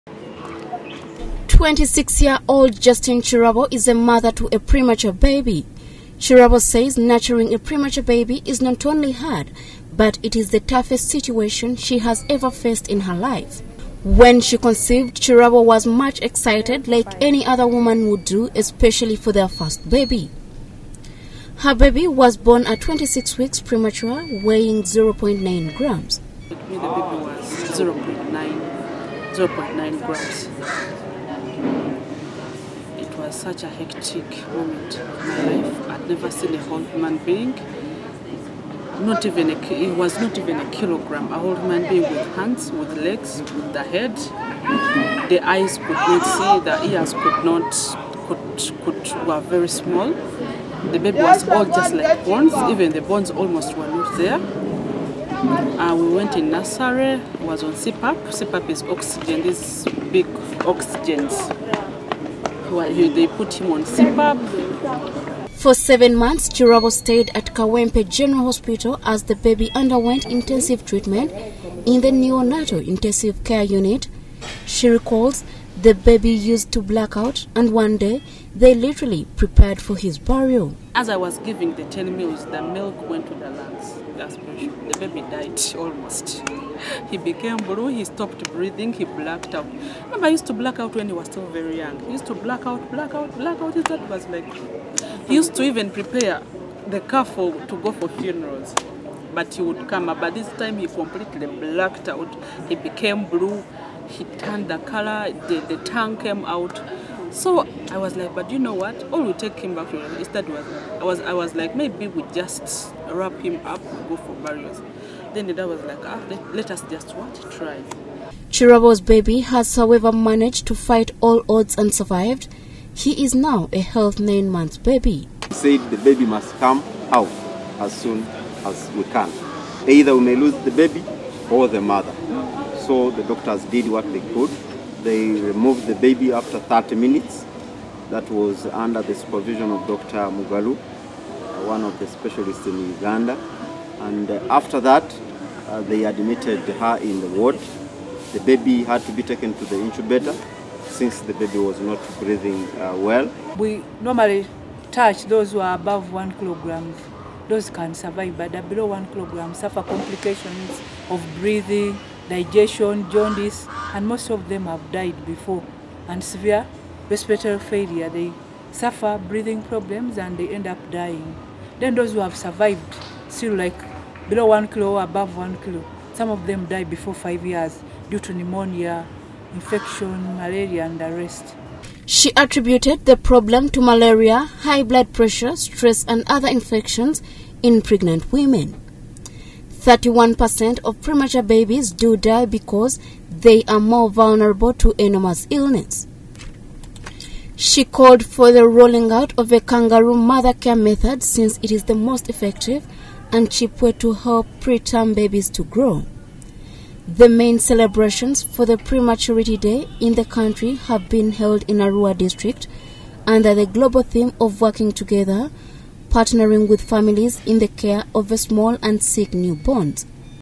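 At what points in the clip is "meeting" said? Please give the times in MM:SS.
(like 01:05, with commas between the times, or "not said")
not said.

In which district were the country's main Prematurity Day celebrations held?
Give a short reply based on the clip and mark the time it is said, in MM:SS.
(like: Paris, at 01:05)
Arua, at 03:31.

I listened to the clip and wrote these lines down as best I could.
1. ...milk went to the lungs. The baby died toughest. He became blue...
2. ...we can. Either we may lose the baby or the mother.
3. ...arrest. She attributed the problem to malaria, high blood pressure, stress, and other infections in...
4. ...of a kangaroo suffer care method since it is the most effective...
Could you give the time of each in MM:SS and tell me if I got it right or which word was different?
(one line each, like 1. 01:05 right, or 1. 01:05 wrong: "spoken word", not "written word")
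1. 01:22 wrong: "almost", not "toughest"
2. 02:08 right
3. 03:01 right
4. 03:19 wrong: "mother", not "suffer".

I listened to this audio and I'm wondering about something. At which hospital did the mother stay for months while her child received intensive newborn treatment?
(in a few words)
Kawempe General Hospital.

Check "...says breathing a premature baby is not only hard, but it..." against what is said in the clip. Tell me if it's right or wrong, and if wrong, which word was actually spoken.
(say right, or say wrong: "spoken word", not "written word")
wrong: "nurturing", not "breathing".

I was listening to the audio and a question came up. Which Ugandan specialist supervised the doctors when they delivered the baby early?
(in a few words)
Dr. Mugalu.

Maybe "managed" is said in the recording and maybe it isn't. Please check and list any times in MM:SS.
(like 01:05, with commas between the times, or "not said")
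02:00.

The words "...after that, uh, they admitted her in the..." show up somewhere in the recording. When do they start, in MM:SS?
02:24.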